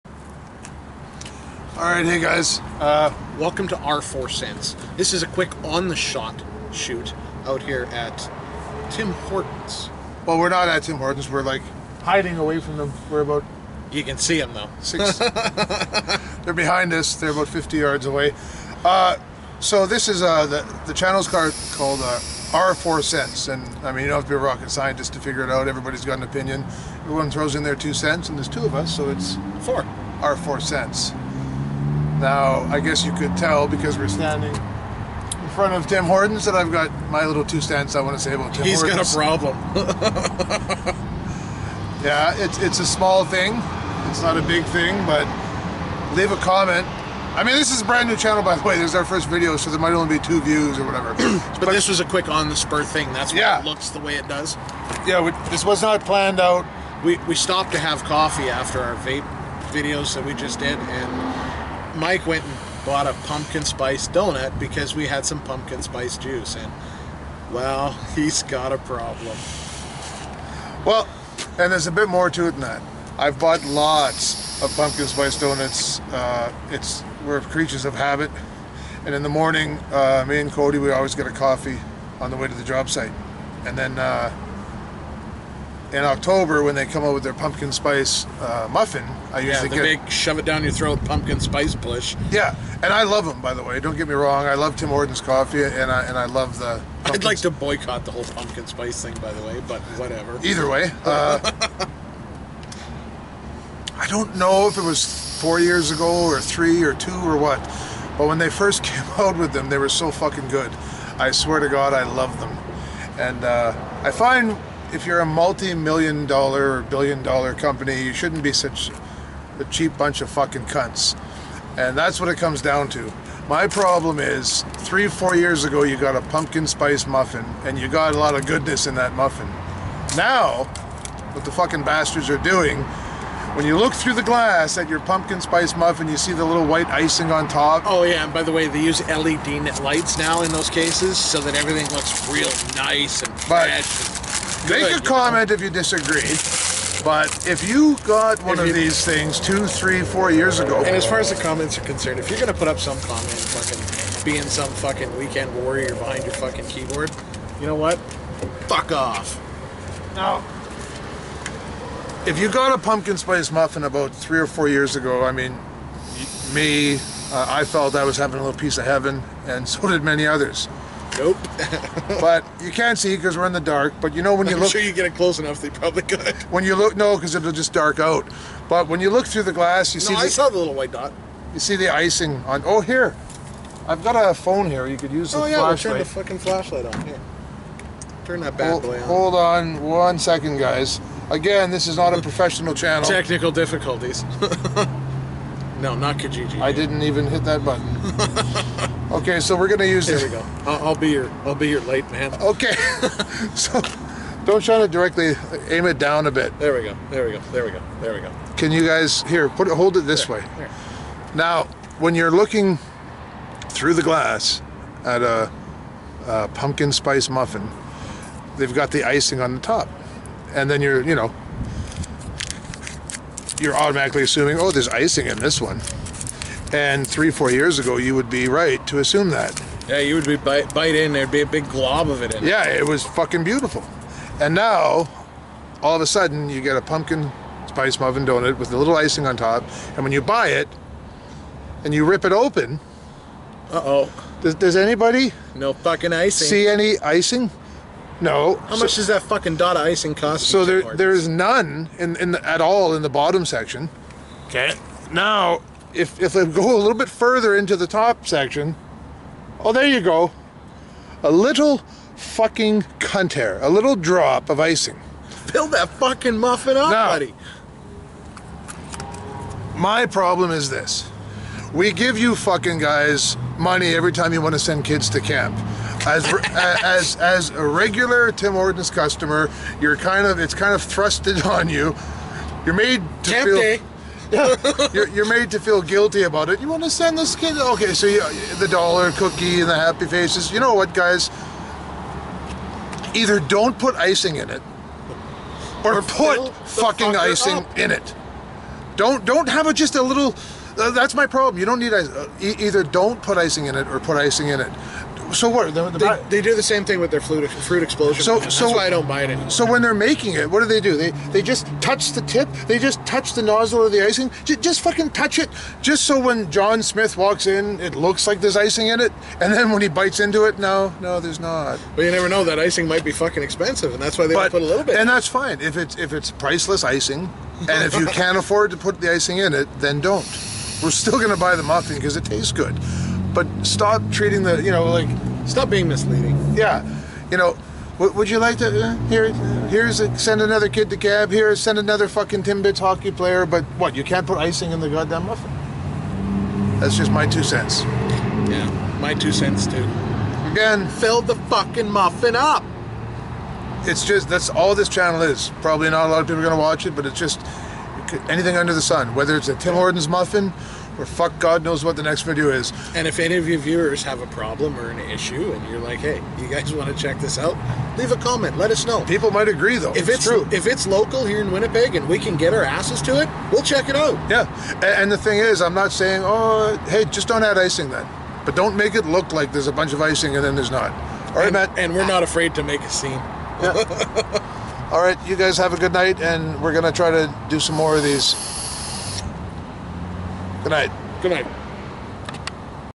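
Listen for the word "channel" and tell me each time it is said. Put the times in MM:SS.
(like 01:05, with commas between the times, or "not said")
00:20, 00:48, 03:12, 05:54.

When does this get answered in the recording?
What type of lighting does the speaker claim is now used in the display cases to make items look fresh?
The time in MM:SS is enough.
02:19.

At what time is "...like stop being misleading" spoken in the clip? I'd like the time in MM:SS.
05:34.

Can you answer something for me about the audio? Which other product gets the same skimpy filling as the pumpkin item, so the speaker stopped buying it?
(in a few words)
fruit explosion.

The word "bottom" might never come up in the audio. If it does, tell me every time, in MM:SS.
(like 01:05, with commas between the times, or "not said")
04:13.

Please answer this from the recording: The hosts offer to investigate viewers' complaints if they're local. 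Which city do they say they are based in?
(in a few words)
Winnipeg.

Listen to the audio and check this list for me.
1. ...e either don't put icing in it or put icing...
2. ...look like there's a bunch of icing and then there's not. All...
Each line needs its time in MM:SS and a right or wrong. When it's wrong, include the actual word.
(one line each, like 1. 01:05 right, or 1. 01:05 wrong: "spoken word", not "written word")
1. 05:02 right
2. 06:19 right.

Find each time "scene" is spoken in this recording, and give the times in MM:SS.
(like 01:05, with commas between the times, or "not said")
06:22.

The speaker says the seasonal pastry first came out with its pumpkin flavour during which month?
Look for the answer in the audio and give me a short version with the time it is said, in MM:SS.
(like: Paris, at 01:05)
October, at 01:26.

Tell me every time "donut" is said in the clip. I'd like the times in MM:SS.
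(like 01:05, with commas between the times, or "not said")
01:04, 01:15, 03:58.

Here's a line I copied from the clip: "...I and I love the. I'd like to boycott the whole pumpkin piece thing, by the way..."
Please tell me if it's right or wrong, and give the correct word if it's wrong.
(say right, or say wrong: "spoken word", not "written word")
wrong: "spice", not "piece".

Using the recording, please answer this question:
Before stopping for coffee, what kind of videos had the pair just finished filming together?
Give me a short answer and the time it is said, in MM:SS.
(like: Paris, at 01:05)
vape videos, at 00:58.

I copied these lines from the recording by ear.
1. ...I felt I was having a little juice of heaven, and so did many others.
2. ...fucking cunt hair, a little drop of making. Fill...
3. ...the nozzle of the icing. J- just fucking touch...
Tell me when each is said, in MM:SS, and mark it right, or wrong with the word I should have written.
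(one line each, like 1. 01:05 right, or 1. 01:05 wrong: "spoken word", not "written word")
1. 02:47 wrong: "piece", not "juice"
2. 04:22 wrong: "icing", not "making"
3. 05:13 right.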